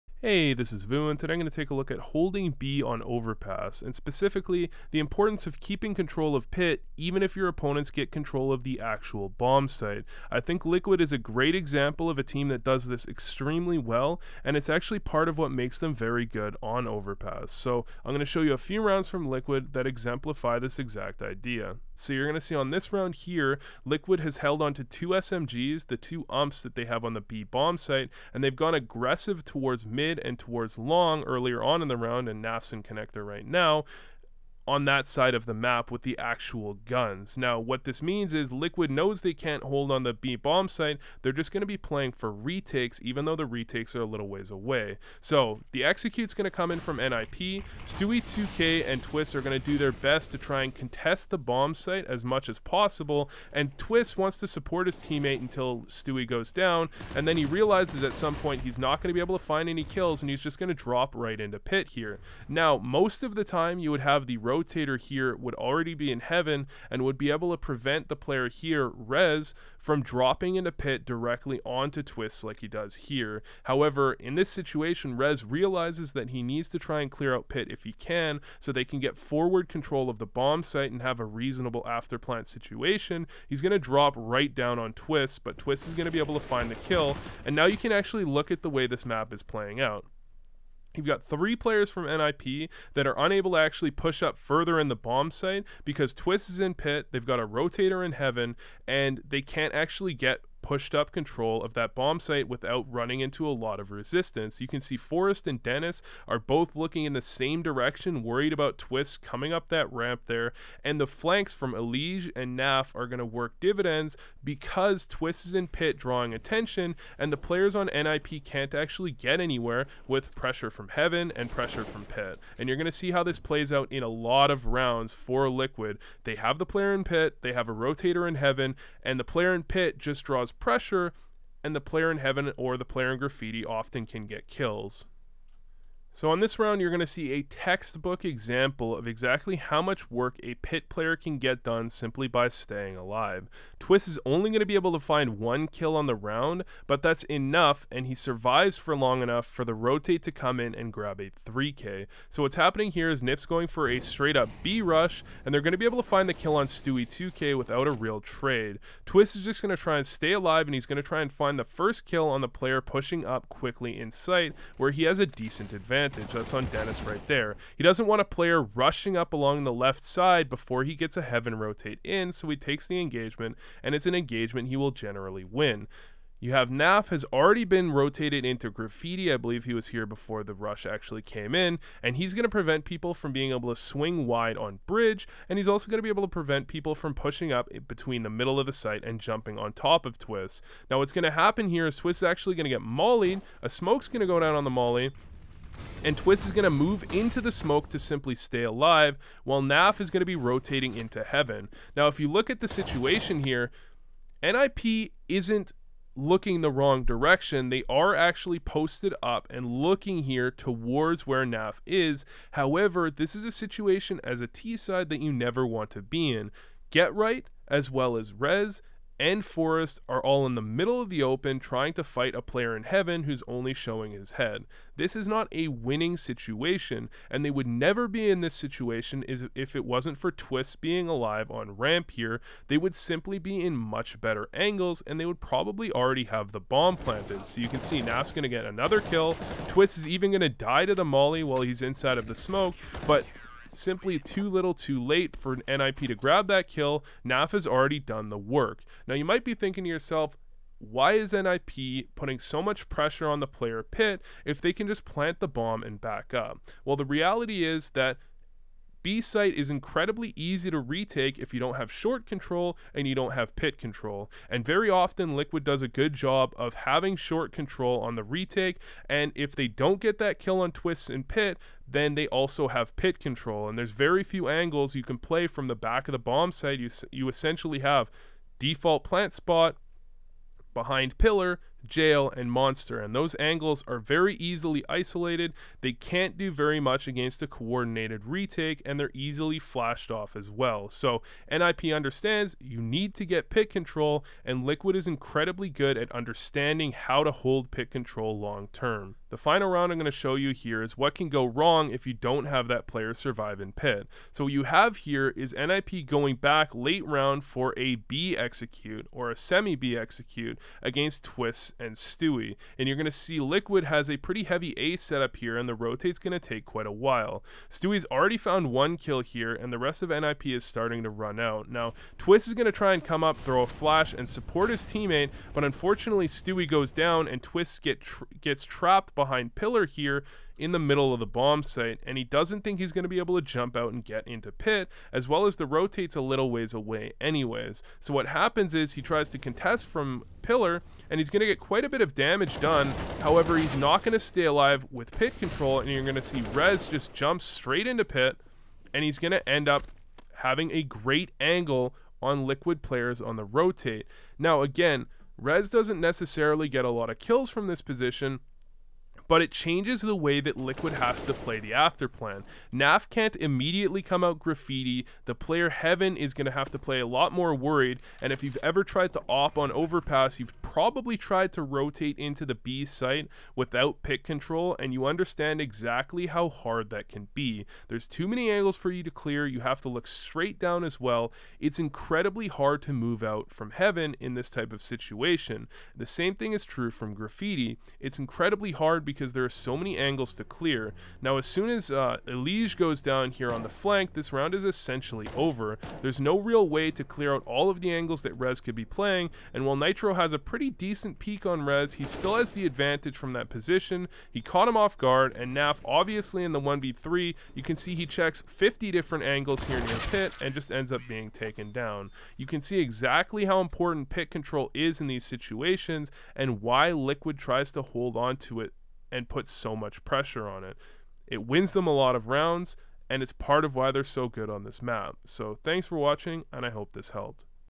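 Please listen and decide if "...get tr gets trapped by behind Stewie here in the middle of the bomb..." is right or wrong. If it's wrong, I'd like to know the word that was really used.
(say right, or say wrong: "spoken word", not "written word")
wrong: "Pillar", not "Stewie".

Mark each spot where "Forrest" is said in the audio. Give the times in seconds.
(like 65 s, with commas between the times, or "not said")
104 s, 219 s.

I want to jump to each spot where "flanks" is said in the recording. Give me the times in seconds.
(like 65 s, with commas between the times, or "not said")
111 s, 393 s.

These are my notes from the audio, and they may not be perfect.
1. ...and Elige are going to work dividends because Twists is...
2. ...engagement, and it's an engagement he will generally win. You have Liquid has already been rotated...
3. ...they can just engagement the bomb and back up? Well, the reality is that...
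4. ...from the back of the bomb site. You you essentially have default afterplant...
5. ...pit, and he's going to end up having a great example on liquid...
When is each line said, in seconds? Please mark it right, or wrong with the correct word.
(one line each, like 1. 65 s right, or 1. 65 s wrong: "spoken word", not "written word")
1. 112 s wrong: "Naf", not "Elige"
2. 173 s wrong: "Naf", not "Liquid"
3. 254 s wrong: "plant", not "engagement"
4. 275 s wrong: "plant", not "afterplant"
5. 348 s wrong: "angle", not "example".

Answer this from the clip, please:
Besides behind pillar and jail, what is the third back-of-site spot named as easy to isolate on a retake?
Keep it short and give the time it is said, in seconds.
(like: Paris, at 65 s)
Monster, at 282 s.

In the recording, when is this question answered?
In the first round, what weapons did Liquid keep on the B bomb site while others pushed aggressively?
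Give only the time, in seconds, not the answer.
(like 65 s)
25 s.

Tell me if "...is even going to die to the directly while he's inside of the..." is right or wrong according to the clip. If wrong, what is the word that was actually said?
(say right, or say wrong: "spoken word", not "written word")
wrong: "molly", not "directly".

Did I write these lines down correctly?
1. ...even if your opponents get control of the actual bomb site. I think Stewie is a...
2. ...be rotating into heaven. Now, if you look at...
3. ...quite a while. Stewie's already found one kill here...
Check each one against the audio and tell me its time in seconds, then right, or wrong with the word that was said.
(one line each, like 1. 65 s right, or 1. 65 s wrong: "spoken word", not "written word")
1. 6 s wrong: "Liquid", not "Stewie"
2. 200 s right
3. 316 s right.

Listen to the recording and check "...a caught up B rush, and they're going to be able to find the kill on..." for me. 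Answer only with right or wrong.
wrong.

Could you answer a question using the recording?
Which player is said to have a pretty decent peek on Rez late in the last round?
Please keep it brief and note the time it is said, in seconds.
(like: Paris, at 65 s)
Nitro, at 399 s.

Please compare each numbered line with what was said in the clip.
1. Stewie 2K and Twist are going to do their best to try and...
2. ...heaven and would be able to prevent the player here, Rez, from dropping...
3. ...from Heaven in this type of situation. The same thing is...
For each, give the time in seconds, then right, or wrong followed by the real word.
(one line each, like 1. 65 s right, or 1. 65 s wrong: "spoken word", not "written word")
1. 47 s right
2. 66 s right
3. 383 s right.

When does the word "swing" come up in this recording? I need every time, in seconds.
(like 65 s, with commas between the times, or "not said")
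183 s.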